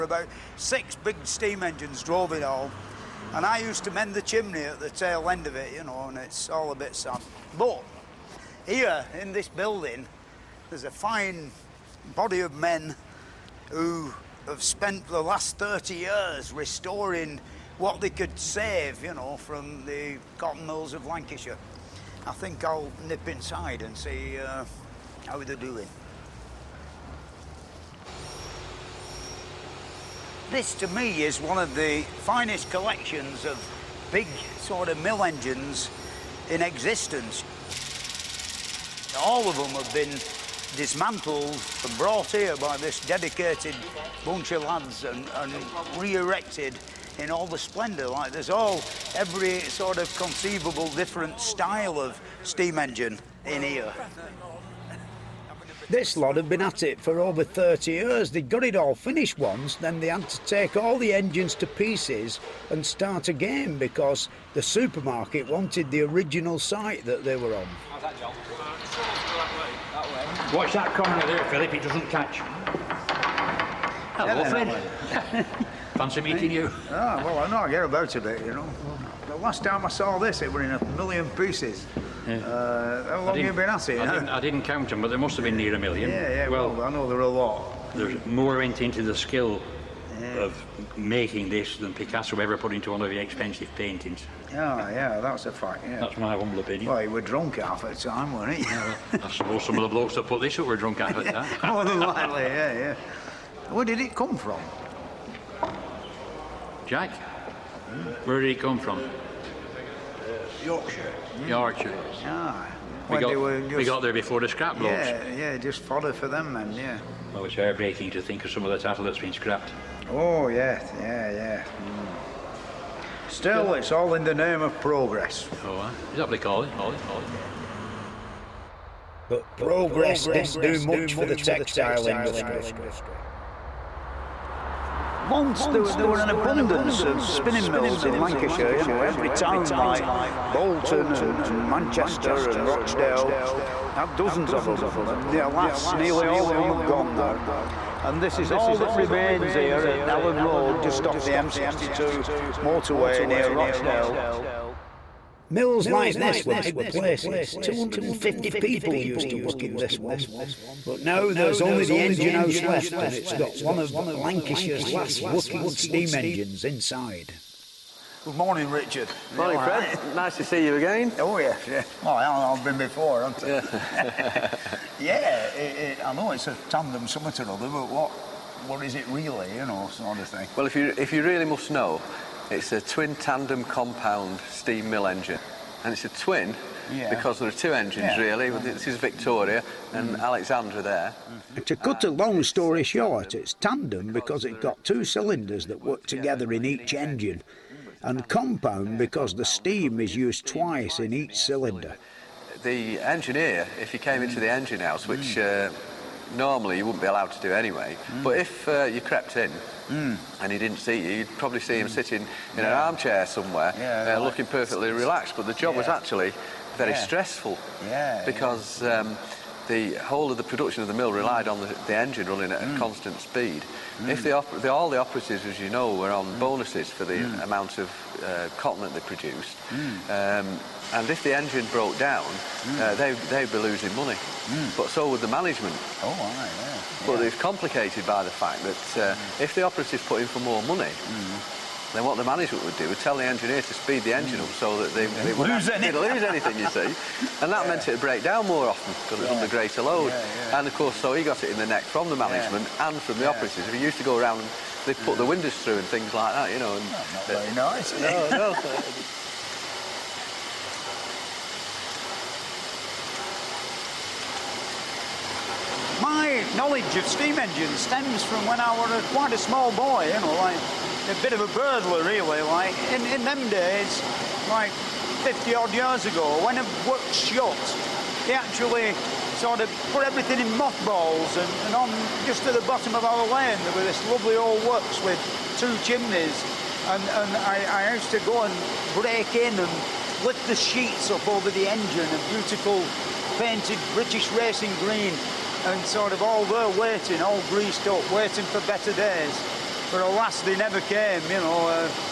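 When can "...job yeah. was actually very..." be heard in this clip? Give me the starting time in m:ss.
3:35.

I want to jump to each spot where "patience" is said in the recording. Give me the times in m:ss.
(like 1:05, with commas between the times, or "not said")
not said.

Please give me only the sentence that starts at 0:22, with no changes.
I think I'll nip inside and see uh, how they're doing.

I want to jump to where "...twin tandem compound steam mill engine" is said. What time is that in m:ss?
3:02.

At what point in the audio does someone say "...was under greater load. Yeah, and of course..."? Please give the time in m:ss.
4:09.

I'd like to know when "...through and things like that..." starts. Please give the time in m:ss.
4:15.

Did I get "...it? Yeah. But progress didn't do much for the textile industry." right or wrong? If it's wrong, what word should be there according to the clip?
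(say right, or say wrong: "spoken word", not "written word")
right.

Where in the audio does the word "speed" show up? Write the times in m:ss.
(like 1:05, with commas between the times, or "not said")
3:43, 4:03.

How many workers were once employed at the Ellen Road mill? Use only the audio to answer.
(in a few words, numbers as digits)
250.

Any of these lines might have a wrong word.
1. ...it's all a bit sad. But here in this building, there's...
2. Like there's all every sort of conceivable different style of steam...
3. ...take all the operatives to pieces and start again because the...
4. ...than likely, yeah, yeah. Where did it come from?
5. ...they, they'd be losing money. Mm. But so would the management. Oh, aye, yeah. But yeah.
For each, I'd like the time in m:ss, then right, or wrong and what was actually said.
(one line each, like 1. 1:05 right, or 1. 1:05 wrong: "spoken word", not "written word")
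1. 0:06 right
2. 0:48 right
3. 1:00 wrong: "engines", not "operatives"
4. 1:41 right
5. 3:52 right.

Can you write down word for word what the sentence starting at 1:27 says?
There's more went into the skill yeah.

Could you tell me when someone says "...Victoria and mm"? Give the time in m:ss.
3:08.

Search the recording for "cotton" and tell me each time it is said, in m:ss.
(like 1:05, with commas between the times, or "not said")
0:20, 3:48.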